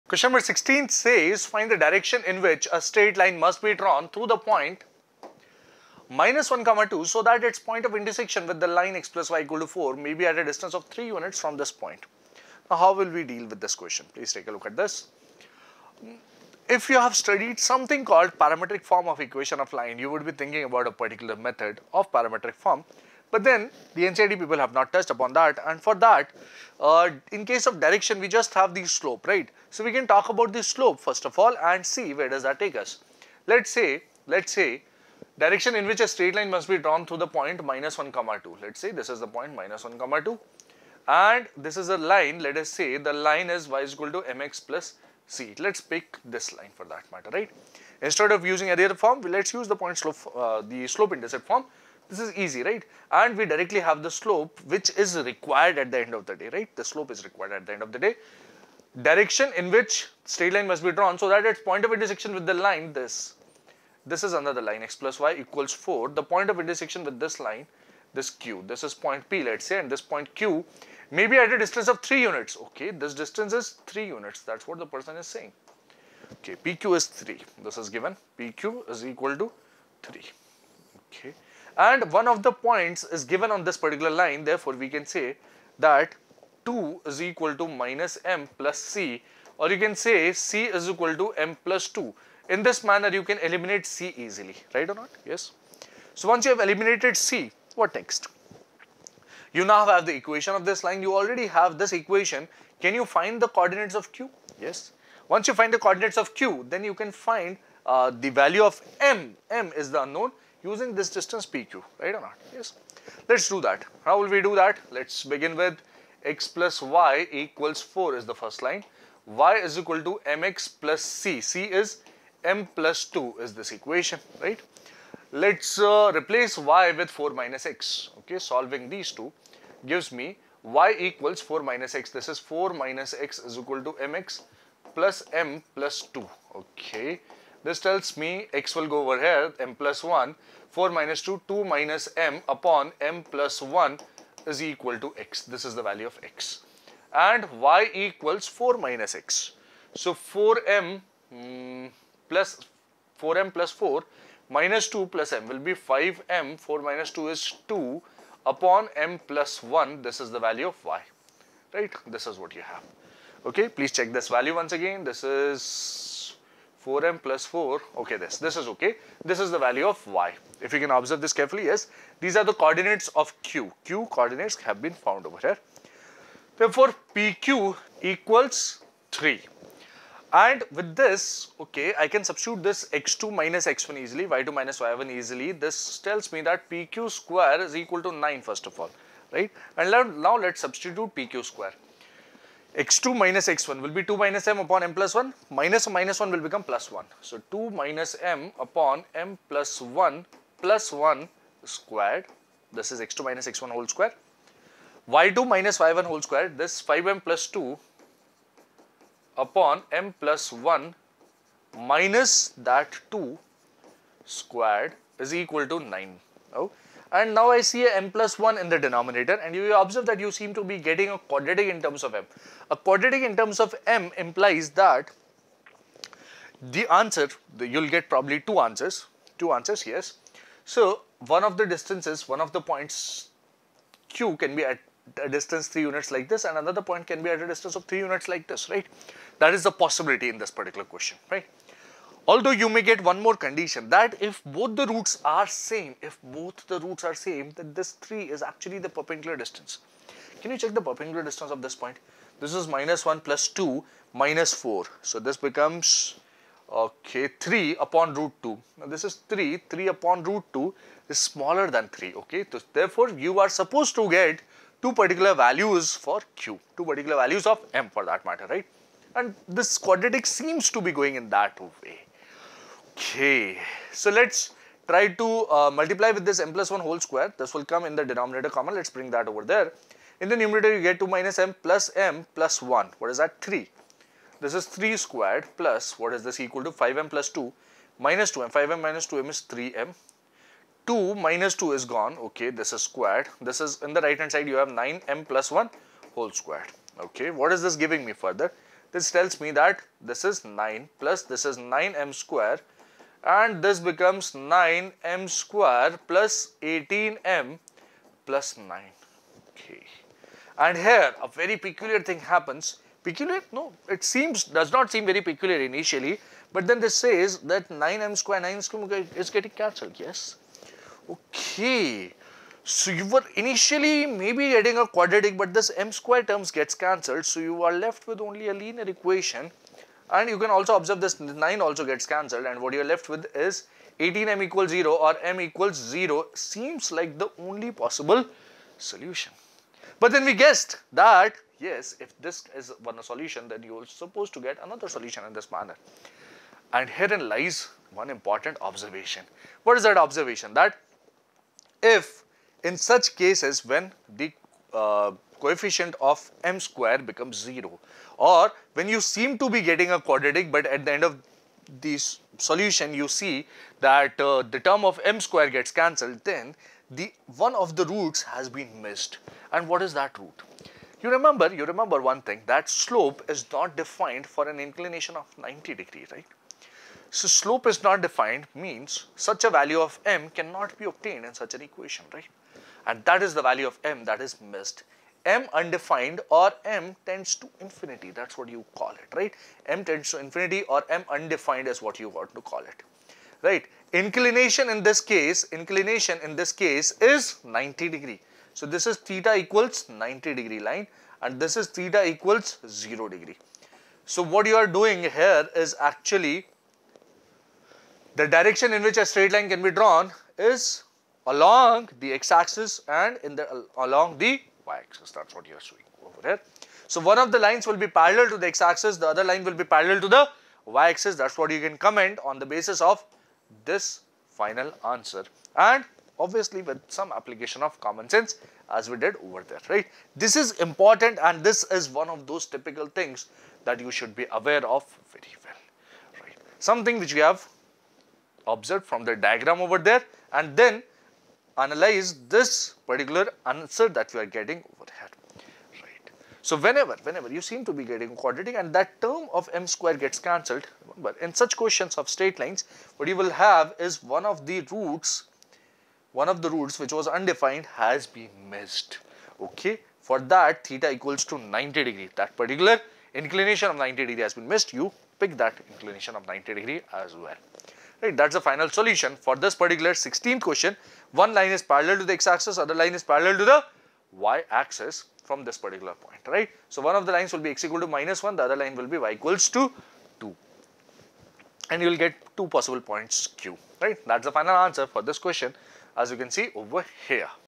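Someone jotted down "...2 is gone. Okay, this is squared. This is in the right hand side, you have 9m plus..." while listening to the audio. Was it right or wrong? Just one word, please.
right.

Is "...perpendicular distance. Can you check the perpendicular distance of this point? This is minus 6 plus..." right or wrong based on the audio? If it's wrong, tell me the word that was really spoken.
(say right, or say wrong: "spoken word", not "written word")
wrong: "1", not "6".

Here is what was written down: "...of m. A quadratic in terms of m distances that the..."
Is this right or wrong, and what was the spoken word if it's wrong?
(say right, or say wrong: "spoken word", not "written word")
wrong: "implies", not "distances".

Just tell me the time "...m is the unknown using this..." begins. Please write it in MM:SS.
01:49.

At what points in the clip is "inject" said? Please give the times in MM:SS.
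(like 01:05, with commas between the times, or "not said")
not said.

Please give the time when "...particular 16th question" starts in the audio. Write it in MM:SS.
07:49.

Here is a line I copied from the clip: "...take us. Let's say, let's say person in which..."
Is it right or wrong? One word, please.
wrong.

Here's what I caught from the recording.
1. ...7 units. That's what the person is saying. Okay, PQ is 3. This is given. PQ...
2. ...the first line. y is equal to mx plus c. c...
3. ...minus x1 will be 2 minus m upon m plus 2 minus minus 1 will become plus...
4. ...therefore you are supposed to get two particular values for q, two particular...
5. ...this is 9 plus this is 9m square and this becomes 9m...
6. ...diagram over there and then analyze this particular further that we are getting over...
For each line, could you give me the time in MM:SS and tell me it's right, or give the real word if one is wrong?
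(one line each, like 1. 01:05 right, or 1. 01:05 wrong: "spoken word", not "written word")
1. 01:13 wrong: "3", not "7"
2. 01:58 right
3. 03:13 wrong: "1", not "2"
4. 04:22 right
5. 04:59 right
6. 07:19 wrong: "answer", not "further".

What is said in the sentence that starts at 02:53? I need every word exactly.
q coordinates have been found over here.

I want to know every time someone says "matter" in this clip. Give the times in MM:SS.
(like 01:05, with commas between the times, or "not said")
00:47, 04:28.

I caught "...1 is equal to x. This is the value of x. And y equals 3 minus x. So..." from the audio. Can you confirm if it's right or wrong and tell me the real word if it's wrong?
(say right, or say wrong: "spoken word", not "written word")
wrong: "4", not "3".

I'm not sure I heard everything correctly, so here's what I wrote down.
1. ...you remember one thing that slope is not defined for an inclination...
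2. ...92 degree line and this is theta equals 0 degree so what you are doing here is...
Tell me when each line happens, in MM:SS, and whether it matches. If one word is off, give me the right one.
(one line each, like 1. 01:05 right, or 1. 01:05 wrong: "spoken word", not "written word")
1. 06:11 right
2. 06:39 wrong: "90", not "92".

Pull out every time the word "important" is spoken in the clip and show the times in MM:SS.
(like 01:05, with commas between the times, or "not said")
05:48, 07:10.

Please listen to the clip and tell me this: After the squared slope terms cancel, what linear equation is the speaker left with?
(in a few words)
18m = 0.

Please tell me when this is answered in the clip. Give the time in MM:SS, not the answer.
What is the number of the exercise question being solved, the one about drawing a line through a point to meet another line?
00:00.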